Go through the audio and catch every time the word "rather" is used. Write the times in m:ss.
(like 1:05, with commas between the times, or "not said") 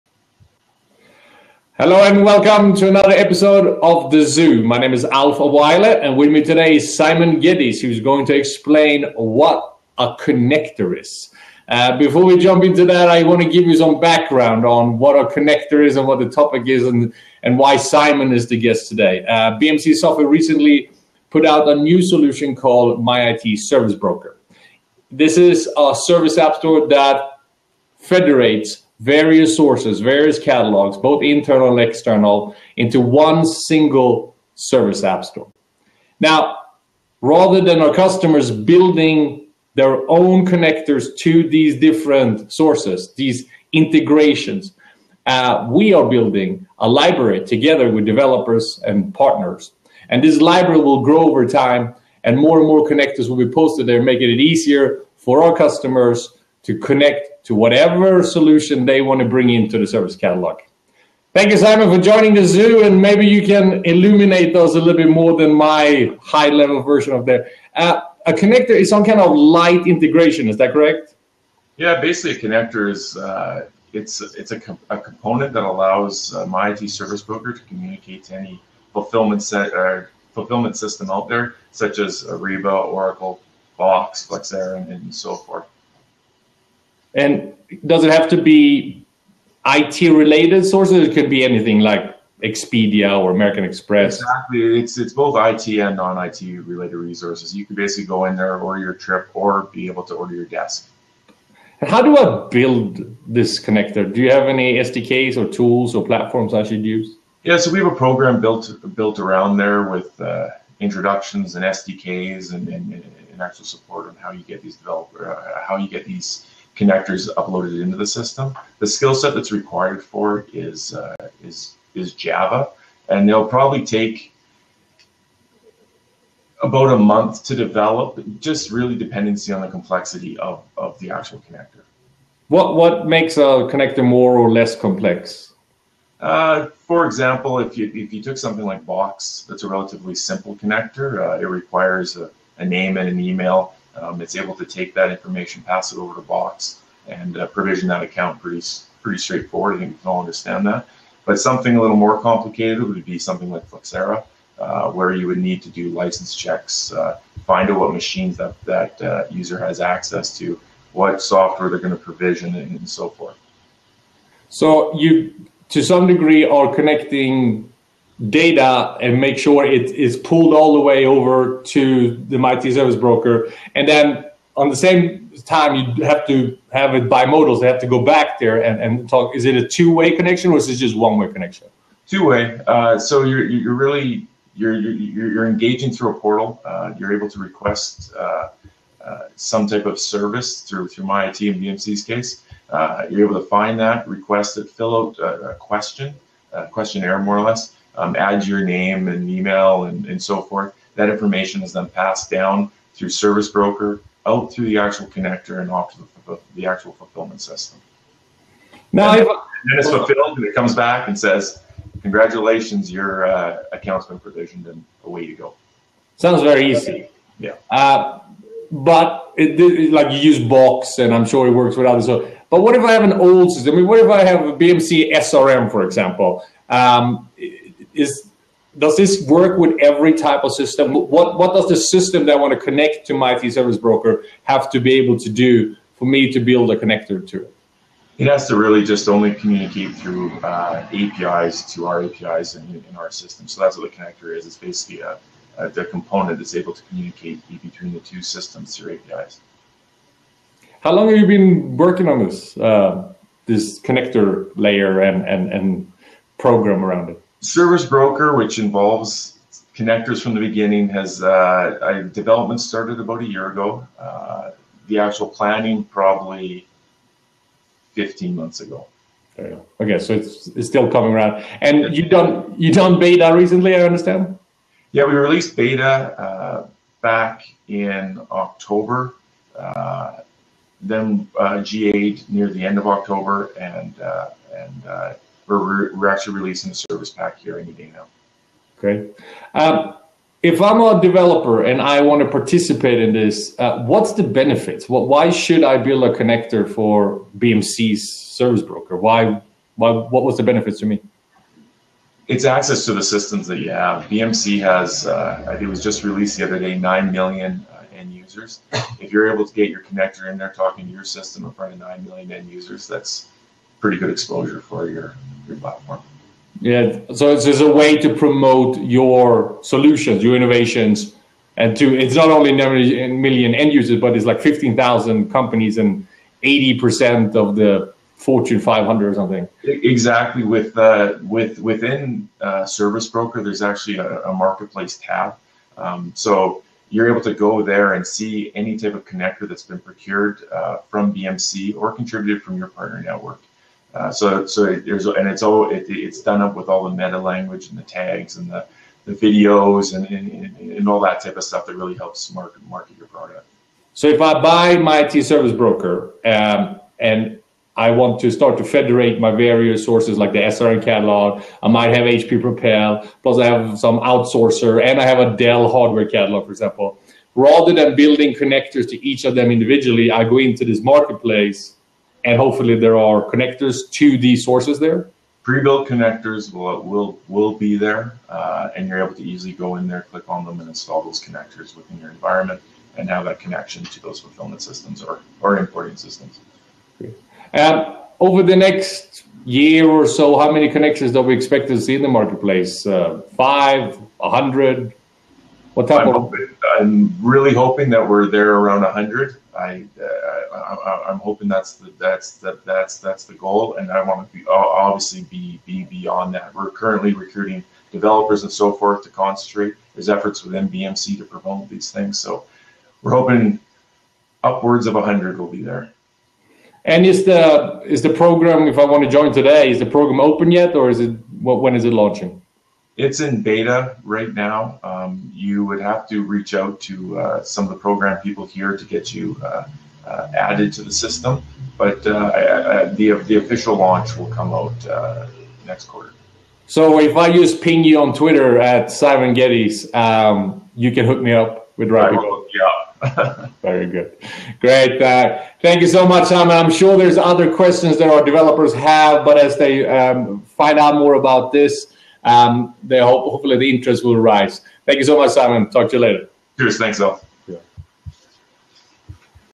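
0:37, 6:07.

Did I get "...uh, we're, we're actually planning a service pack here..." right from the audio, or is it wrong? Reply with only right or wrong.
wrong.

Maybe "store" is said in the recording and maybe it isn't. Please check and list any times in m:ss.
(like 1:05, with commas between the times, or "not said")
0:26, 0:35.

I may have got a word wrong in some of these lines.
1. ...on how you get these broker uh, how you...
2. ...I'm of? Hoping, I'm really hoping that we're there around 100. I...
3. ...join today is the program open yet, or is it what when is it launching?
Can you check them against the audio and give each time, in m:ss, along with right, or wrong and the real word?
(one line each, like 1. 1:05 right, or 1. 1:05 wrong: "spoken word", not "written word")
1. 1:54 wrong: "developer", not "broker"
2. 6:36 right
3. 6:59 right.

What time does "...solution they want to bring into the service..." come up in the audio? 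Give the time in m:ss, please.
0:58.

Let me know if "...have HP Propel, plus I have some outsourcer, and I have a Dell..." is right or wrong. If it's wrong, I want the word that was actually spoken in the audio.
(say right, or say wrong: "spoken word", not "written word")
right.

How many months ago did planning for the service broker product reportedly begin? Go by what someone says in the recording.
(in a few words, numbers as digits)
15 months.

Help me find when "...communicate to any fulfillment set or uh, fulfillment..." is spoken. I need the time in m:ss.
1:17.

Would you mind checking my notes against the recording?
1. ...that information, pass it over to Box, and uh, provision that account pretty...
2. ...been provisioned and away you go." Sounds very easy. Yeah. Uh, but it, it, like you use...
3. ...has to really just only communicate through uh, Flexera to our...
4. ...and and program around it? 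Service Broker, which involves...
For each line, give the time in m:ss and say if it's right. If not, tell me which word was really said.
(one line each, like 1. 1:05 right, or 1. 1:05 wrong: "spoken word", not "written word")
1. 2:24 right
2. 3:34 right
3. 3:58 wrong: "APIs", not "Flexera"
4. 4:15 right.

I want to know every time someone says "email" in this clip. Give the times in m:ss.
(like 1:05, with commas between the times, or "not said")
2:23, 3:19.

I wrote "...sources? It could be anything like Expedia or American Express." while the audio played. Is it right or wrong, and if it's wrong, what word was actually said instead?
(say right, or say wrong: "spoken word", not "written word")
right.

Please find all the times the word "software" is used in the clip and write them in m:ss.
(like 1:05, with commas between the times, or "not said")
0:19, 2:41.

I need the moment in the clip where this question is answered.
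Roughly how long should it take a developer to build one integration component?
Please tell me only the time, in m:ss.
2:06.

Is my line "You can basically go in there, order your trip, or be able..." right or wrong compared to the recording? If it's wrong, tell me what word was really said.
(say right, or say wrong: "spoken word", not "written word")
right.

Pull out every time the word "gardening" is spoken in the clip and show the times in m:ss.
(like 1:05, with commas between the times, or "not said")
not said.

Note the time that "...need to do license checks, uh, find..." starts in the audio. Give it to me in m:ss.
2:35.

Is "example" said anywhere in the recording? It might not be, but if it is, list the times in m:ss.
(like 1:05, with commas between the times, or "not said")
2:17, 3:45, 6:06.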